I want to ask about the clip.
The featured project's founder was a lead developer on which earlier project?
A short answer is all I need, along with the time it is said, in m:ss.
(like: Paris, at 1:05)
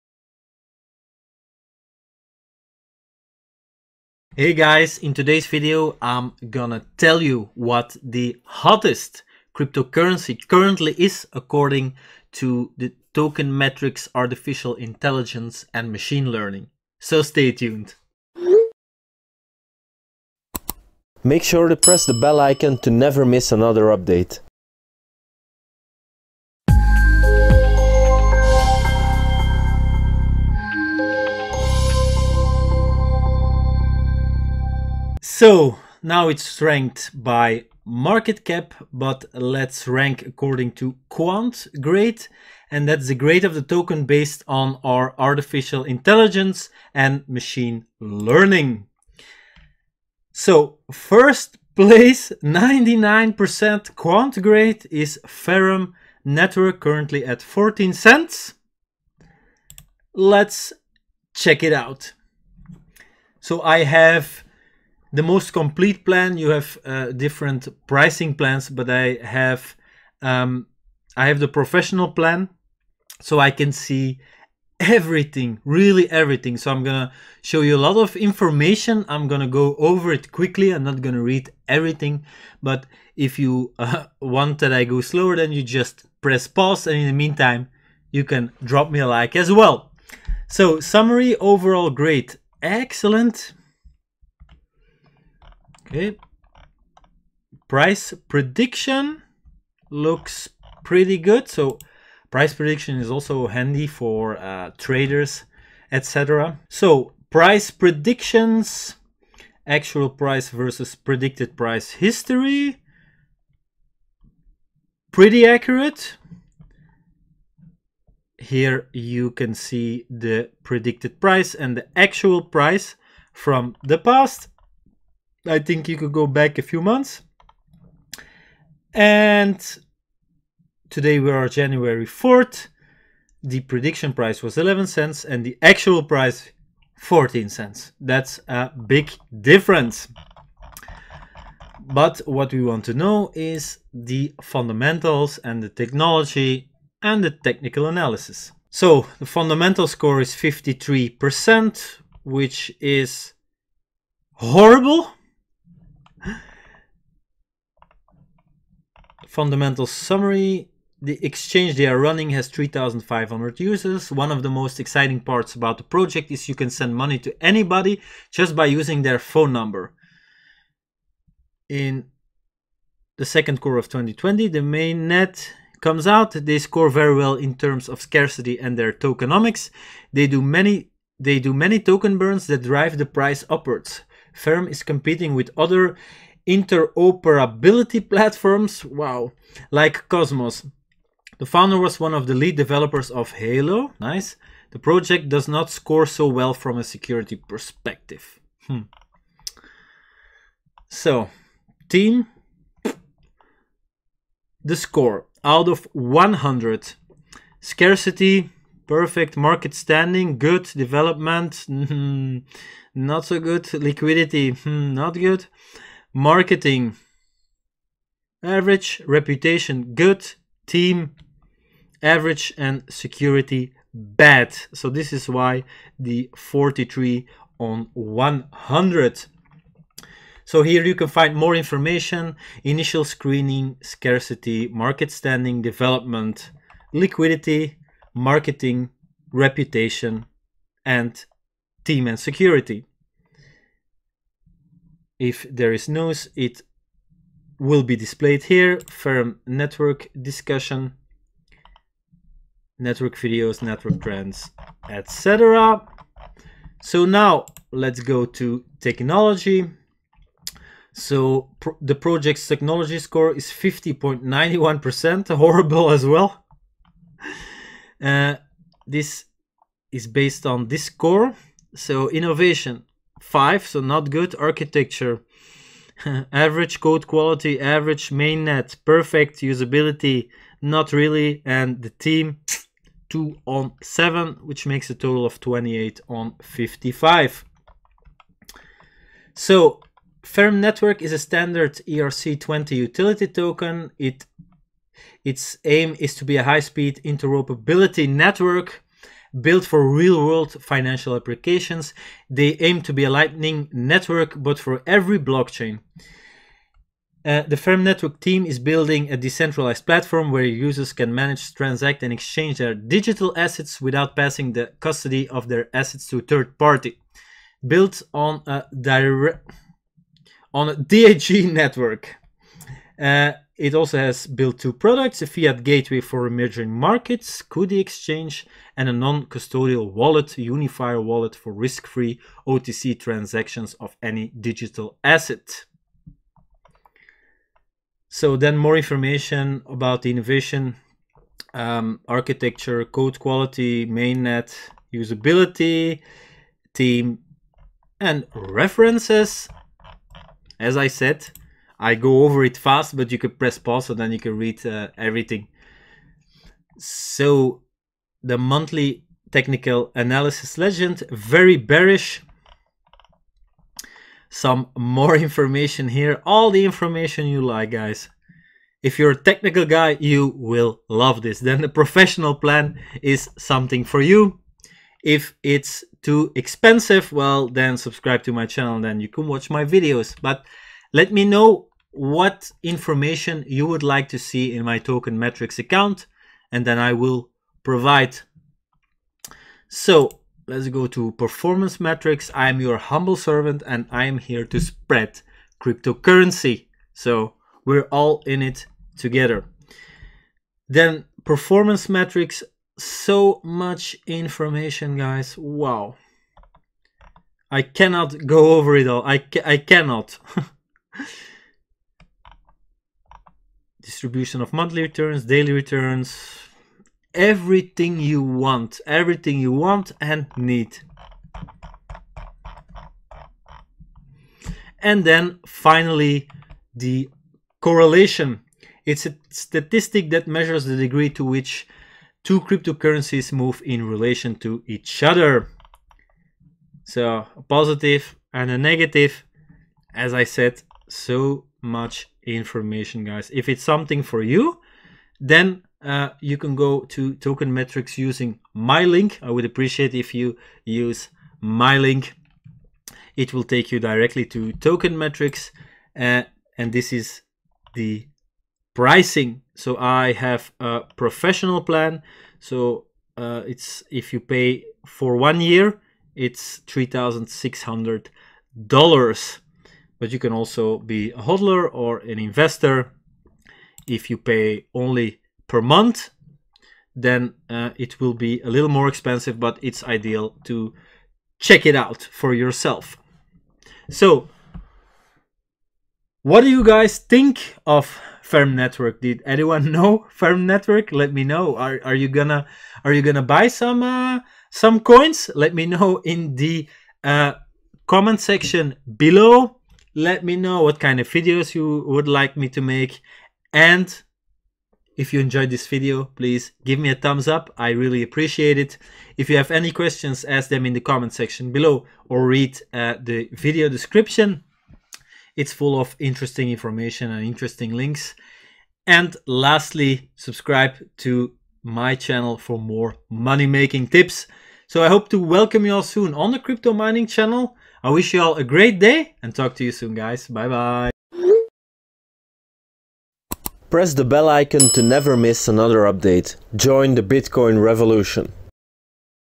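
Halo, at 3:13.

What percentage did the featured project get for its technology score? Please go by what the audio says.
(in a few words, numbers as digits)
50.91%.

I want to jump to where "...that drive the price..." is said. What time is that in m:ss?
3:02.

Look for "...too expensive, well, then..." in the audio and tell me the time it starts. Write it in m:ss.
6:16.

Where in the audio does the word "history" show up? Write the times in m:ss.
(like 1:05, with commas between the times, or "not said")
1:51.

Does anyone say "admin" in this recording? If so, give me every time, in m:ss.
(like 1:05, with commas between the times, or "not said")
not said.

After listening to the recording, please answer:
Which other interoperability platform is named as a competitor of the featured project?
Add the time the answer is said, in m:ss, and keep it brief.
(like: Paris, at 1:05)
Cosmos, at 3:10.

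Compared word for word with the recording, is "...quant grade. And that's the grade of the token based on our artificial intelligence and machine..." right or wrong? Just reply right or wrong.
right.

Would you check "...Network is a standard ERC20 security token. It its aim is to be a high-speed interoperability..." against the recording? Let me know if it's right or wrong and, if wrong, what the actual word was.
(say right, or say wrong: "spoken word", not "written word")
wrong: "utility", not "security".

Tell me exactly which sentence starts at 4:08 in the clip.
Ferrum network discussion, network videos, network trends, etc.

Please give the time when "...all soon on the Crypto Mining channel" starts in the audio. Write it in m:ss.
8:45.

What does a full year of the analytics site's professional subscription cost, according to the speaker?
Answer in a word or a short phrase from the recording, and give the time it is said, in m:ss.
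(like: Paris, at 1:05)
$3,600, at 7:46.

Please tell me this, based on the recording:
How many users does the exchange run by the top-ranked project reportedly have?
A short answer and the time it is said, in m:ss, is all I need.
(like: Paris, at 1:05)
3,500, at 2:42.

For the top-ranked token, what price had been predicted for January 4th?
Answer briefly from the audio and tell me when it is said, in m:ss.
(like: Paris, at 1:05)
11 cents, at 2:14.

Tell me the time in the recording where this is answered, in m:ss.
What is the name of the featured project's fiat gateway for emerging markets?
5:27.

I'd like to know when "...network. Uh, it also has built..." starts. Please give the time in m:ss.
5:21.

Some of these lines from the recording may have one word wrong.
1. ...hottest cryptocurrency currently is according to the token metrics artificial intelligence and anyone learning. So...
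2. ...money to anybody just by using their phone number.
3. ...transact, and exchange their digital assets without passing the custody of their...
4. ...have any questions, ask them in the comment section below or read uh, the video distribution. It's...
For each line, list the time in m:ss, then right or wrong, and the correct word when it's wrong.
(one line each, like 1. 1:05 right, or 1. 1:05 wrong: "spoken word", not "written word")
1. 0:08 wrong: "machine", not "anyone"
2. 2:46 right
3. 5:11 right
4. 8:29 wrong: "description", not "distribution".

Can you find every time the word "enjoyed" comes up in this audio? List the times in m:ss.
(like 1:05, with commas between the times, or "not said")
8:25.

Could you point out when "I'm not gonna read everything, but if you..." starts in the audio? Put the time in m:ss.
1:20.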